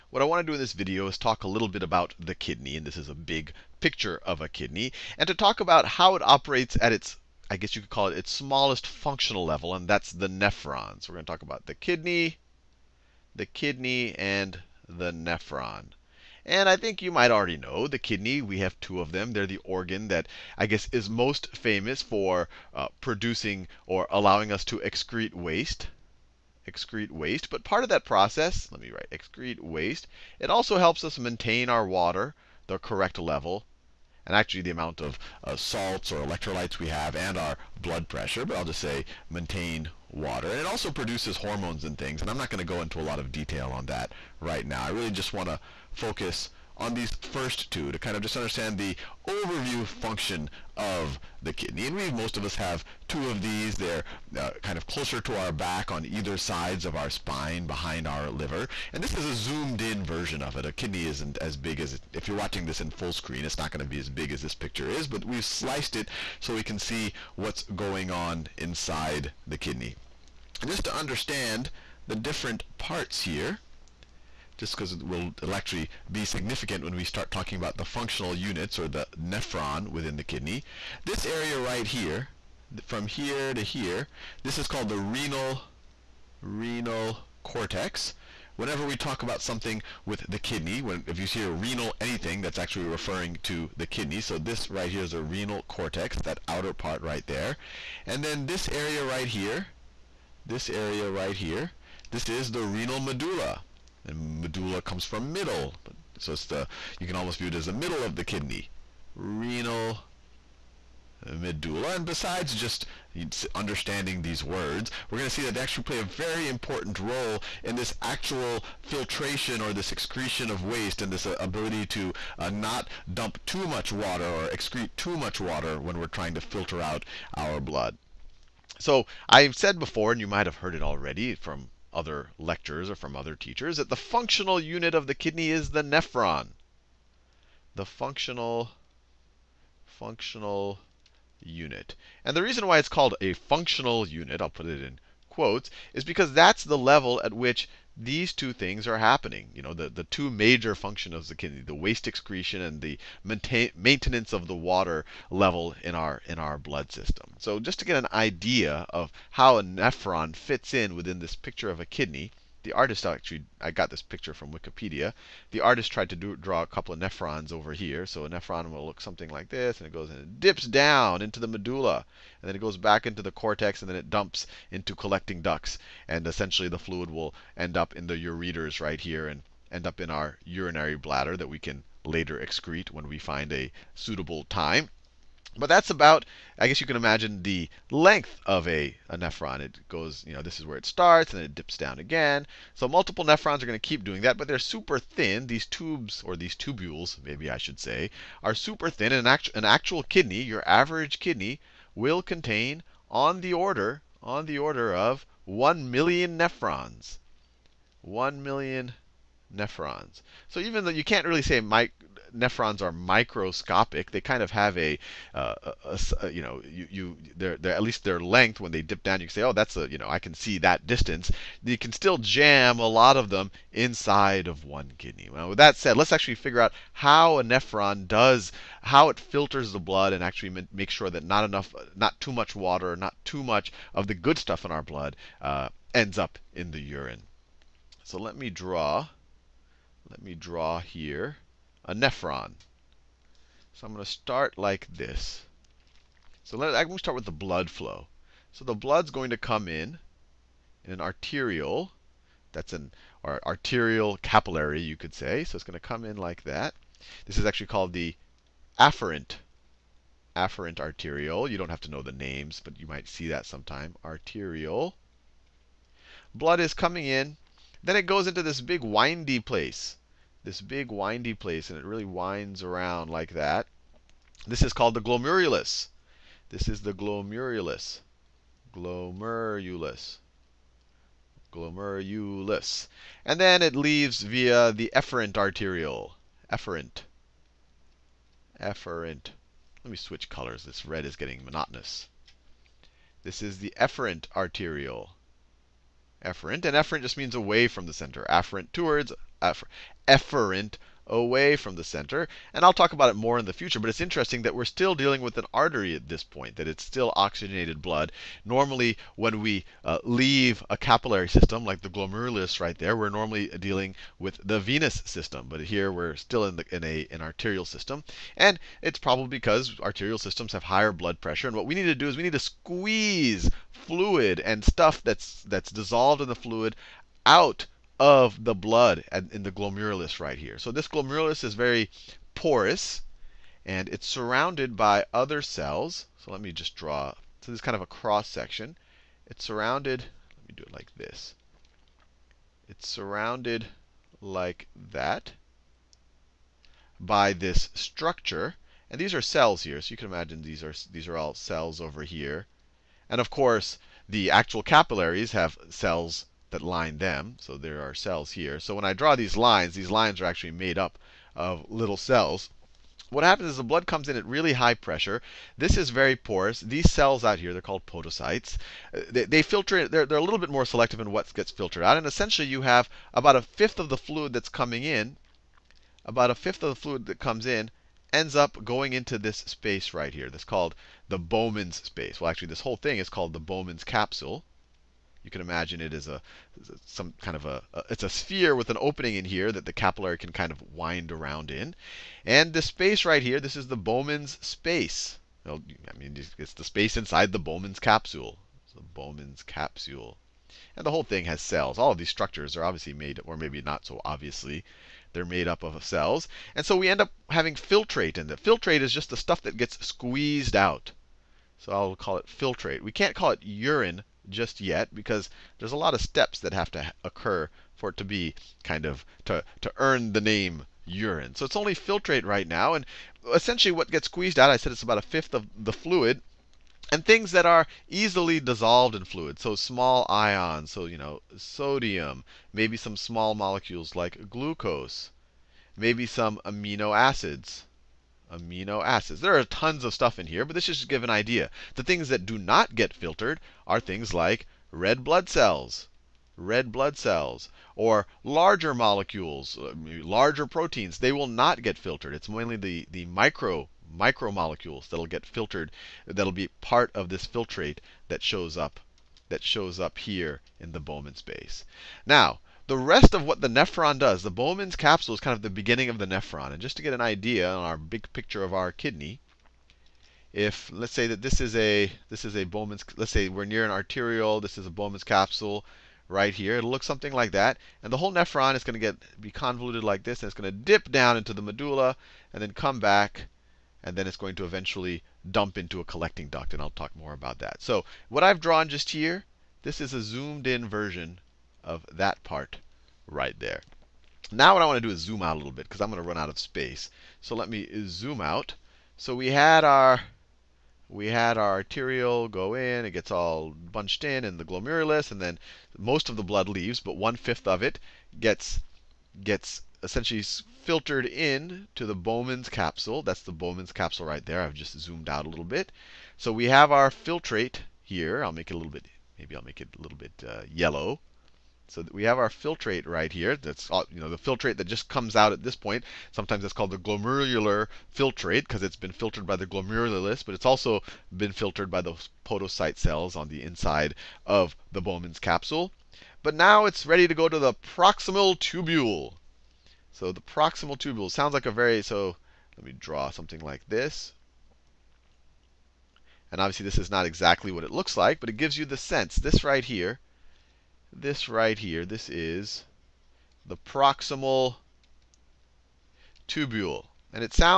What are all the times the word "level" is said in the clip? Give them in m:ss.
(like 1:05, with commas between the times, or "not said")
0:09, 0:33, 2:26, 2:35.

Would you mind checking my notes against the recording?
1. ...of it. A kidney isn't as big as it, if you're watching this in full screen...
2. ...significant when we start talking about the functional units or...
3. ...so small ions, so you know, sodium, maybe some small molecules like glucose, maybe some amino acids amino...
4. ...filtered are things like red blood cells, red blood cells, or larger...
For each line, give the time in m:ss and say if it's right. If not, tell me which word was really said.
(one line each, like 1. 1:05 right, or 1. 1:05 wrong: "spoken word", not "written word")
1. 1:00 right
2. 1:16 right
3. 7:09 right
4. 7:22 right.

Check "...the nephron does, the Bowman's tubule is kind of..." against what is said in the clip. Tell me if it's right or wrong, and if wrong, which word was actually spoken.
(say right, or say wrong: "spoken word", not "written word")
wrong: "capsule", not "tubule".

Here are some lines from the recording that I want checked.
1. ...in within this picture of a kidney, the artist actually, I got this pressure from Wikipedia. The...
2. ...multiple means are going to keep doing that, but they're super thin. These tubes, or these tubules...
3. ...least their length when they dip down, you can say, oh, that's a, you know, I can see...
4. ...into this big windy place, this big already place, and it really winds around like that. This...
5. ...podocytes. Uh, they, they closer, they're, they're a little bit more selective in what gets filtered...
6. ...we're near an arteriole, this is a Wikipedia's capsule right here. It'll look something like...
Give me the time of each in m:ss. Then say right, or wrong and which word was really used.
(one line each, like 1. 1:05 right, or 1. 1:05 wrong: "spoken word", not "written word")
1. 2:40 wrong: "picture", not "pressure"
2. 3:12 wrong: "nephrons", not "means"
3. 3:37 right
4. 4:28 wrong: "windy", not "already"
5. 6:07 wrong: "filter", not "closer"
6. 7:53 wrong: "Bowman", not "Wikipedia".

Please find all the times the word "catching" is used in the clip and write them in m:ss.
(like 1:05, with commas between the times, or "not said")
not said.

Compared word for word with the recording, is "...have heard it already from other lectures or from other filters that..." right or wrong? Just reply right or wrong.
wrong.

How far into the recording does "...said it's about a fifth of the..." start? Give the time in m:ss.
7:04.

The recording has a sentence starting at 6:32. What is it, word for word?
And this space right here, this is the Bowman's space.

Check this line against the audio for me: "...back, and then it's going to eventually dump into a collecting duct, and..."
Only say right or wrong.
right.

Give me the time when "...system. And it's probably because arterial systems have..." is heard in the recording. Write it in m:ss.
5:17.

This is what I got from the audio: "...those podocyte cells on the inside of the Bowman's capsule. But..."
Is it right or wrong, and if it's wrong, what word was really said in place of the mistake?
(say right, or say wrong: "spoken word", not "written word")
right.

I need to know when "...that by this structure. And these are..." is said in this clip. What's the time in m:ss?
5:44.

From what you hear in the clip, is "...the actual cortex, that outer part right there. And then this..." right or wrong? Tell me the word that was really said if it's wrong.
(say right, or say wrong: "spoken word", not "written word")
wrong: "renal", not "actual".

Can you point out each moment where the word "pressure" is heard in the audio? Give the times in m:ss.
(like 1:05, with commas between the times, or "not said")
0:38, 5:21, 6:04.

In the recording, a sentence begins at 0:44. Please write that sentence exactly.
I really just want to focus on these first two to kind of just understand the overview function of the kidney.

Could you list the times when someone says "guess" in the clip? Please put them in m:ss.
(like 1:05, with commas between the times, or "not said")
0:07, 0:20, 3:06.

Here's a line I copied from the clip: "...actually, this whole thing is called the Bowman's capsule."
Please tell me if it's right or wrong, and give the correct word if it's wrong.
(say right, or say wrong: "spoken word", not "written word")
right.